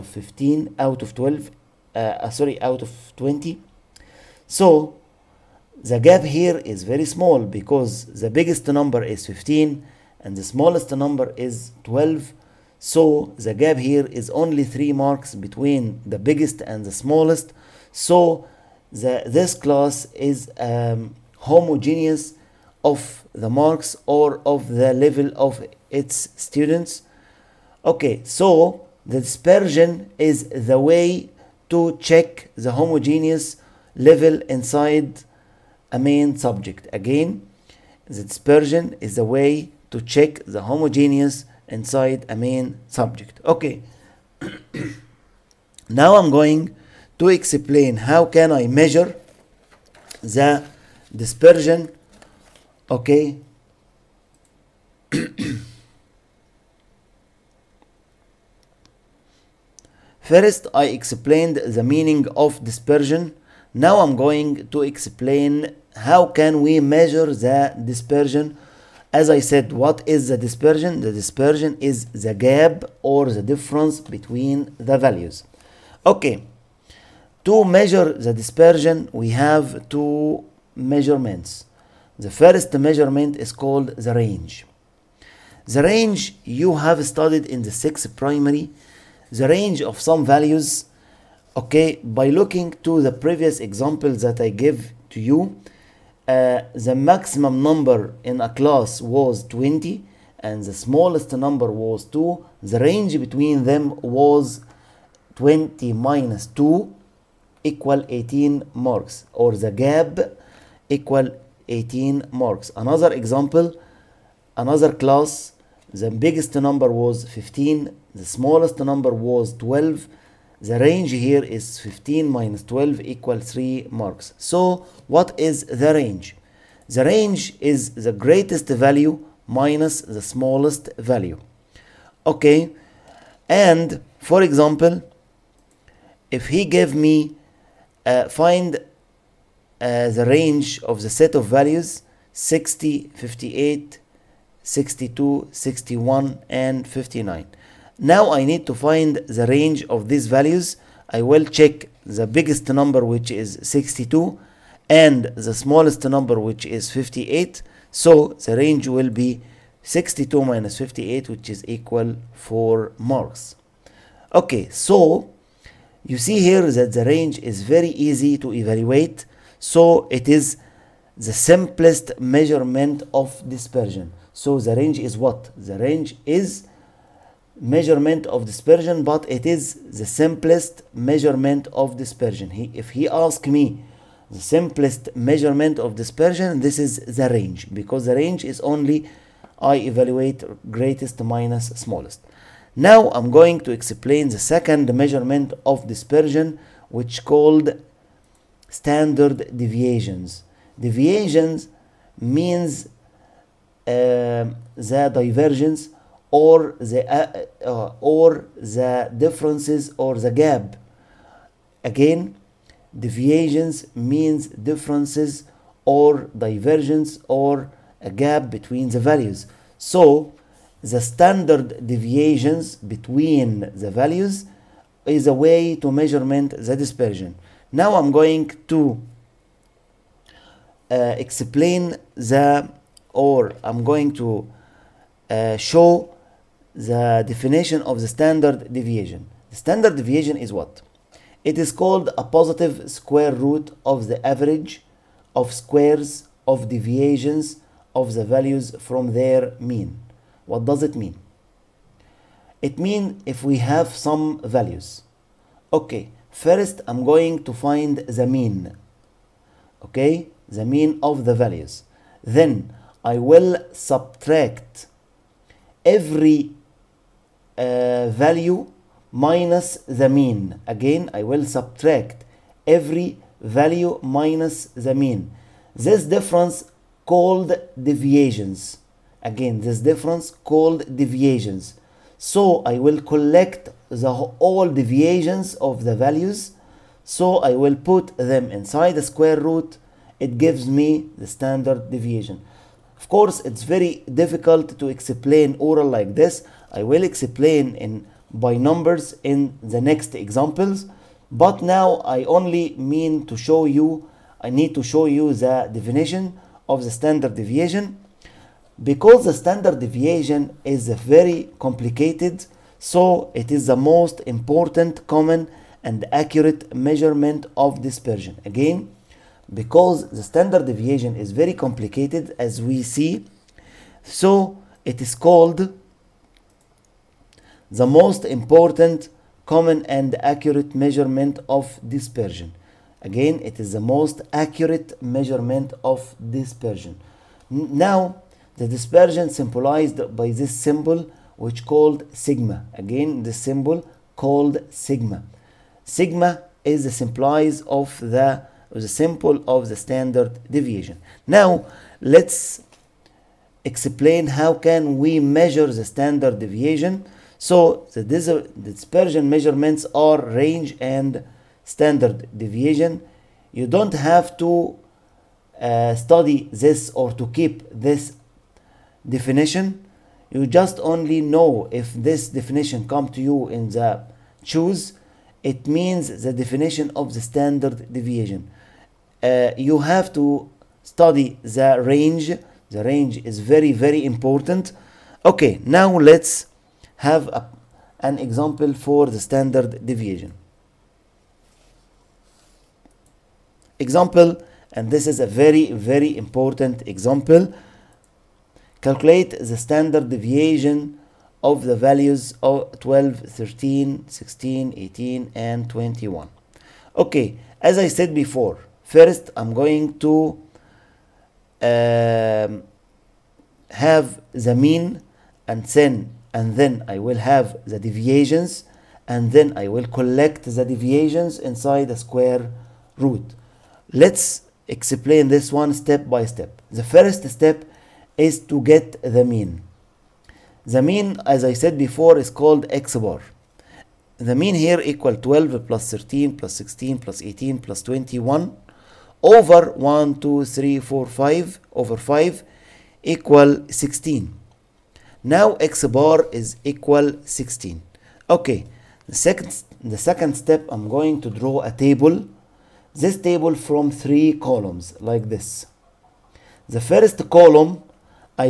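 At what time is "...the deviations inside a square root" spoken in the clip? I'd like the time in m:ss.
7:00.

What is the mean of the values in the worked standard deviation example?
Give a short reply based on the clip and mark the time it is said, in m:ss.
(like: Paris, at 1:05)
16, at 7:25.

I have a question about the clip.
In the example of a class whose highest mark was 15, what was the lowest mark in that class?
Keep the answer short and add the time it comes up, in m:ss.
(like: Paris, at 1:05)
12, at 0:10.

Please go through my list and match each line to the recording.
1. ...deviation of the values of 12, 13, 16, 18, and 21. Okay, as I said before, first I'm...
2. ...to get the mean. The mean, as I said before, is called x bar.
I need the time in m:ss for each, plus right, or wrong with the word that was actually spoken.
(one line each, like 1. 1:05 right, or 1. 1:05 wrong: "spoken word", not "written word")
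1. 6:40 right
2. 7:08 right.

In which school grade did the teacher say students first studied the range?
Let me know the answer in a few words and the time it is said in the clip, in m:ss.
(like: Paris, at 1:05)
sixth primary, at 1:27.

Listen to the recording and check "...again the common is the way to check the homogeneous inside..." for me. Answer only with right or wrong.
wrong.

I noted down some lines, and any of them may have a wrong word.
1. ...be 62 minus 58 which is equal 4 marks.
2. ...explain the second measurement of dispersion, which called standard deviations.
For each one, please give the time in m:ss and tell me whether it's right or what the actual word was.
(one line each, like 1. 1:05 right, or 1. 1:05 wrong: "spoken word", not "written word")
1. 2:39 right
2. 3:13 right.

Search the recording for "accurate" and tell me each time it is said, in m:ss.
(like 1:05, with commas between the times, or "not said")
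5:16, 5:30, 5:34.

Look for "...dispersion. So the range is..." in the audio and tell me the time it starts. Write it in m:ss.
2:53.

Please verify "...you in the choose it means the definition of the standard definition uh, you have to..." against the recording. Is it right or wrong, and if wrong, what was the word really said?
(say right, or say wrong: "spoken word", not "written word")
wrong: "deviation", not "definition".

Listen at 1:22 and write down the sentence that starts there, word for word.
The first measurement is called the range.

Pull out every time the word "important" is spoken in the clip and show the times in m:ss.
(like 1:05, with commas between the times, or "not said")
5:14, 5:28, 6:24, 6:36.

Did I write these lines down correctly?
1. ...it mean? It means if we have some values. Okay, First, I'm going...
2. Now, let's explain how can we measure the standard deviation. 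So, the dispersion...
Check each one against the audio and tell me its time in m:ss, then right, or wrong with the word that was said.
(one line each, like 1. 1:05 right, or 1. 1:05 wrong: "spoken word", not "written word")
1. 4:10 right
2. 5:51 right.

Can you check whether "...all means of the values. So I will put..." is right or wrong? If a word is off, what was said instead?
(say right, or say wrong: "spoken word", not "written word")
wrong: "deviations", not "means".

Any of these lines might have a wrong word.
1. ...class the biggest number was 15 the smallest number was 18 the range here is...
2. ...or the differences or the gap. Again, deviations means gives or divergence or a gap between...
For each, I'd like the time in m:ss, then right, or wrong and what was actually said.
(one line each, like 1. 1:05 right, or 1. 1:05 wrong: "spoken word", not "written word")
1. 1:54 wrong: "12", not "18"
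2. 3:27 wrong: "differences", not "gives".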